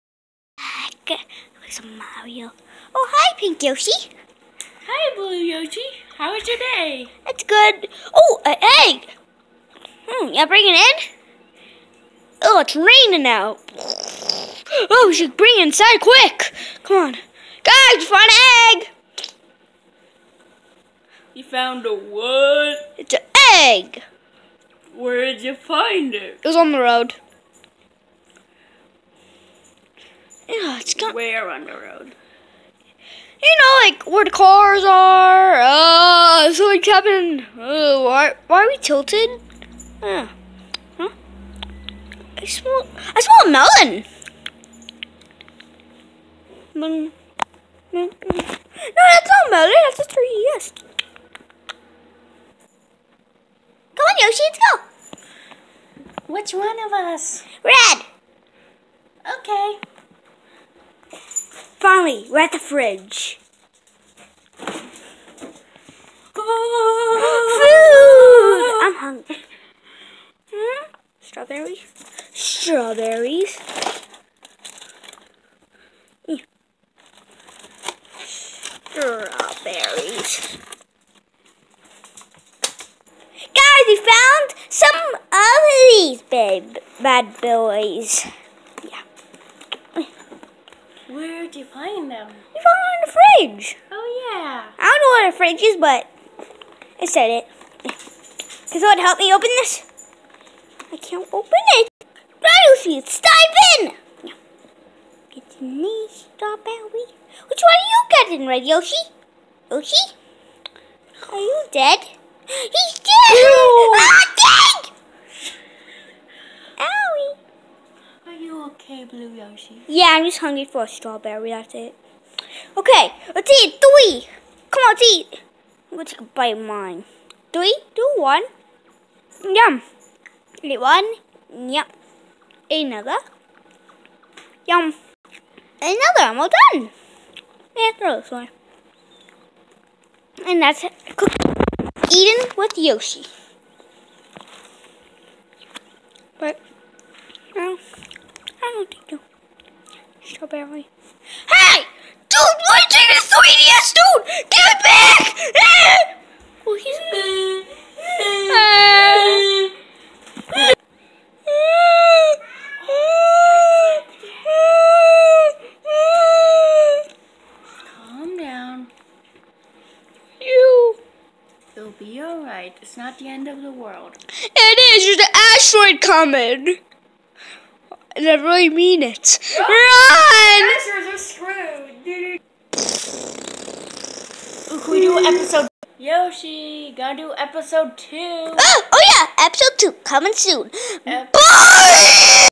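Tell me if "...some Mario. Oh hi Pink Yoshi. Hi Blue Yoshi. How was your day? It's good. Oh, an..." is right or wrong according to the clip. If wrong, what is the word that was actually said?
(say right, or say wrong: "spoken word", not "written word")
right.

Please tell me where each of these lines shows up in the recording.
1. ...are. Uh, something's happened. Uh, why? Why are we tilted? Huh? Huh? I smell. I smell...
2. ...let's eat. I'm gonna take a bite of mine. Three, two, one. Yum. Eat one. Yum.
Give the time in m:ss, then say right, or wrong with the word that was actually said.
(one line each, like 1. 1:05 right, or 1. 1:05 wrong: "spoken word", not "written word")
1. 0:34 right
2. 2:04 right.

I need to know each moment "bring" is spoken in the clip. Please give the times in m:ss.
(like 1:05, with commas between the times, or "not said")
0:10, 0:15.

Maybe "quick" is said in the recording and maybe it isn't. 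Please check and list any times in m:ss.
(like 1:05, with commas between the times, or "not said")
0:15.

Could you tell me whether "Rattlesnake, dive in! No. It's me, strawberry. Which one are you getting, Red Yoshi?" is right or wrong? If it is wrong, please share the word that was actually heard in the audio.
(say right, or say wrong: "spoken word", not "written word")
right.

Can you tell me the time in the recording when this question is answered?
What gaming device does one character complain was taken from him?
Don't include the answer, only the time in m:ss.
2:33.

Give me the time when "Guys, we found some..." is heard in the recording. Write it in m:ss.
1:23.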